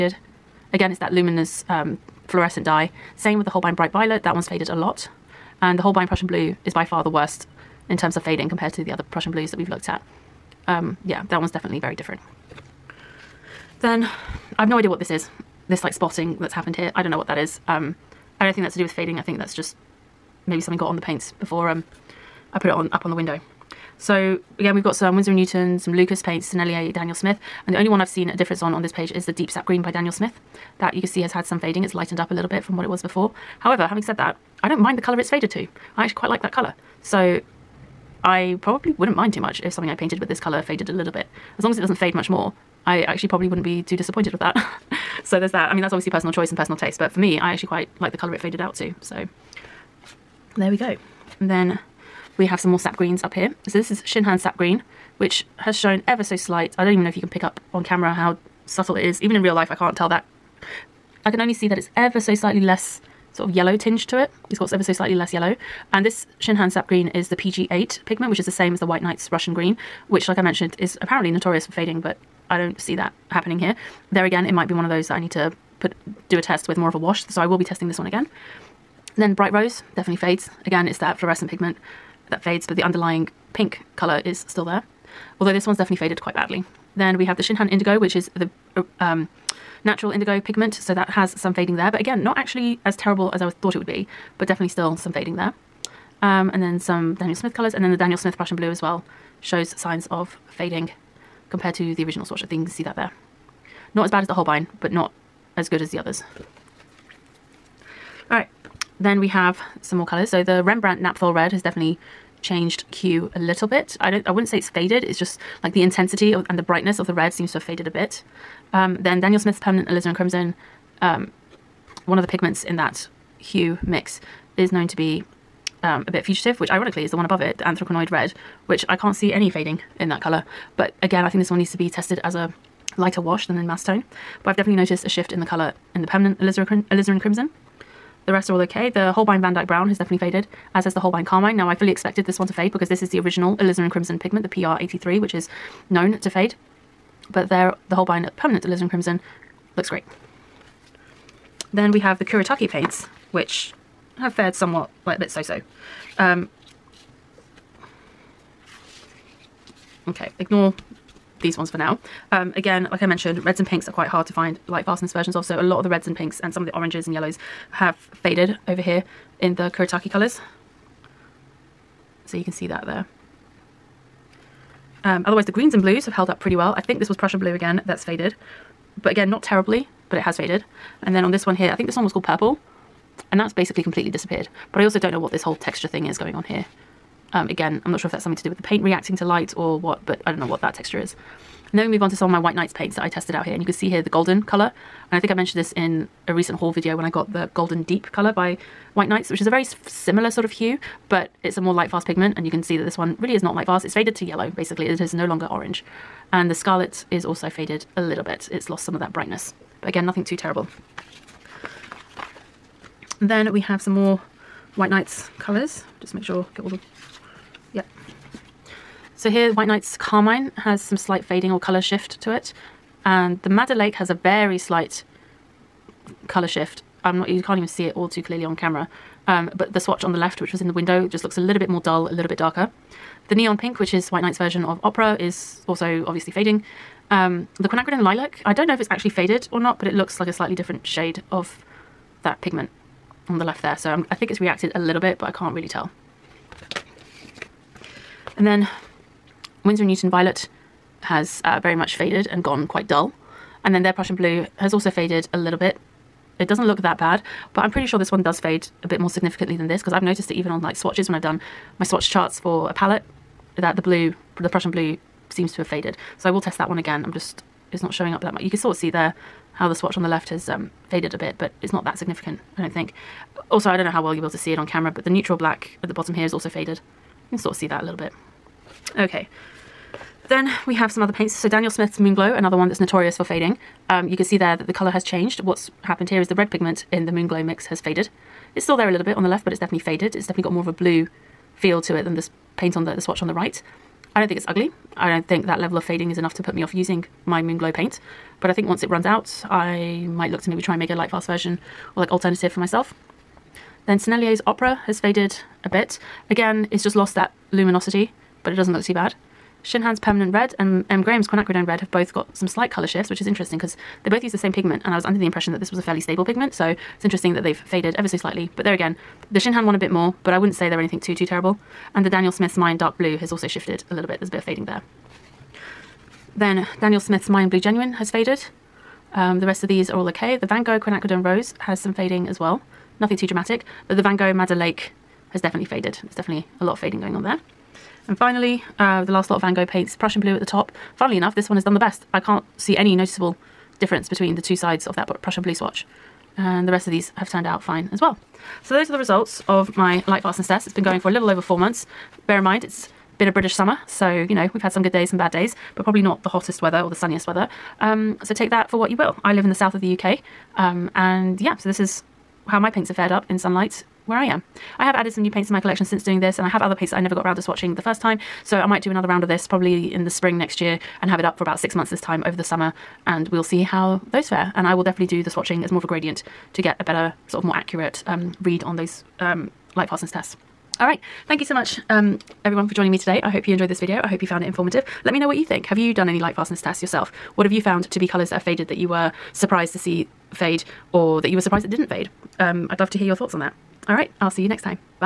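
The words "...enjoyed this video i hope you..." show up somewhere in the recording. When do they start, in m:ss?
6:23.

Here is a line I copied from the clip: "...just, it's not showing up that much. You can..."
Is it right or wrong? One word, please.
right.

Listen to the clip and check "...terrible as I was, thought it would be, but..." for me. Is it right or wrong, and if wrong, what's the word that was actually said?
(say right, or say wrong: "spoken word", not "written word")
right.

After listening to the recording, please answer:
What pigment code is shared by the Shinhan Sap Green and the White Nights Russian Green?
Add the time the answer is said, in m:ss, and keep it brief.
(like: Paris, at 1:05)
PG8, at 1:07.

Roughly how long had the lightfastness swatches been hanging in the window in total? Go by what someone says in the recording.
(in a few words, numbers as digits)
A little over 4 months.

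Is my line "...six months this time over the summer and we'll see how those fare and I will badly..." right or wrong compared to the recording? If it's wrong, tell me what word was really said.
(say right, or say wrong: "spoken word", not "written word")
wrong: "definitely", not "badly".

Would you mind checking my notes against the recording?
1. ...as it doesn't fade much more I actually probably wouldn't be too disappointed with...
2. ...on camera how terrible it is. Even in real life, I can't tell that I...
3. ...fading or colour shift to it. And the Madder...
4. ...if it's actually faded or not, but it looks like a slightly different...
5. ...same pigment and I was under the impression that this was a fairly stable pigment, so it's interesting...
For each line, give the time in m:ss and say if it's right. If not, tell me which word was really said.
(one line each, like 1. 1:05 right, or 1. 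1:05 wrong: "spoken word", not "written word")
1. 0:41 right
2. 0:57 wrong: "subtle", not "terrible"
3. 3:41 right
4. 3:58 right
5. 5:14 right.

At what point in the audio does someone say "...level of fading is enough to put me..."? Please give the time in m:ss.
4:55.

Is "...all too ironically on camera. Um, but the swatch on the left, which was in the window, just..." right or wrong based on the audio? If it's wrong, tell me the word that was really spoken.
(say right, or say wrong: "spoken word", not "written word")
wrong: "clearly", not "ironically".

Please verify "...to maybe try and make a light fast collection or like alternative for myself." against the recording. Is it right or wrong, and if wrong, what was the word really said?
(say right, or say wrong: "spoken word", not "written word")
wrong: "version", not "collection".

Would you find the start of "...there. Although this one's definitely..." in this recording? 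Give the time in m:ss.
1:24.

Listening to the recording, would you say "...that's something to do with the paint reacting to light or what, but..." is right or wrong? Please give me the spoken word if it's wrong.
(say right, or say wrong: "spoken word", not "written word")
right.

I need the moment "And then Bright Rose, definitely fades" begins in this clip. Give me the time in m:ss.
1:19.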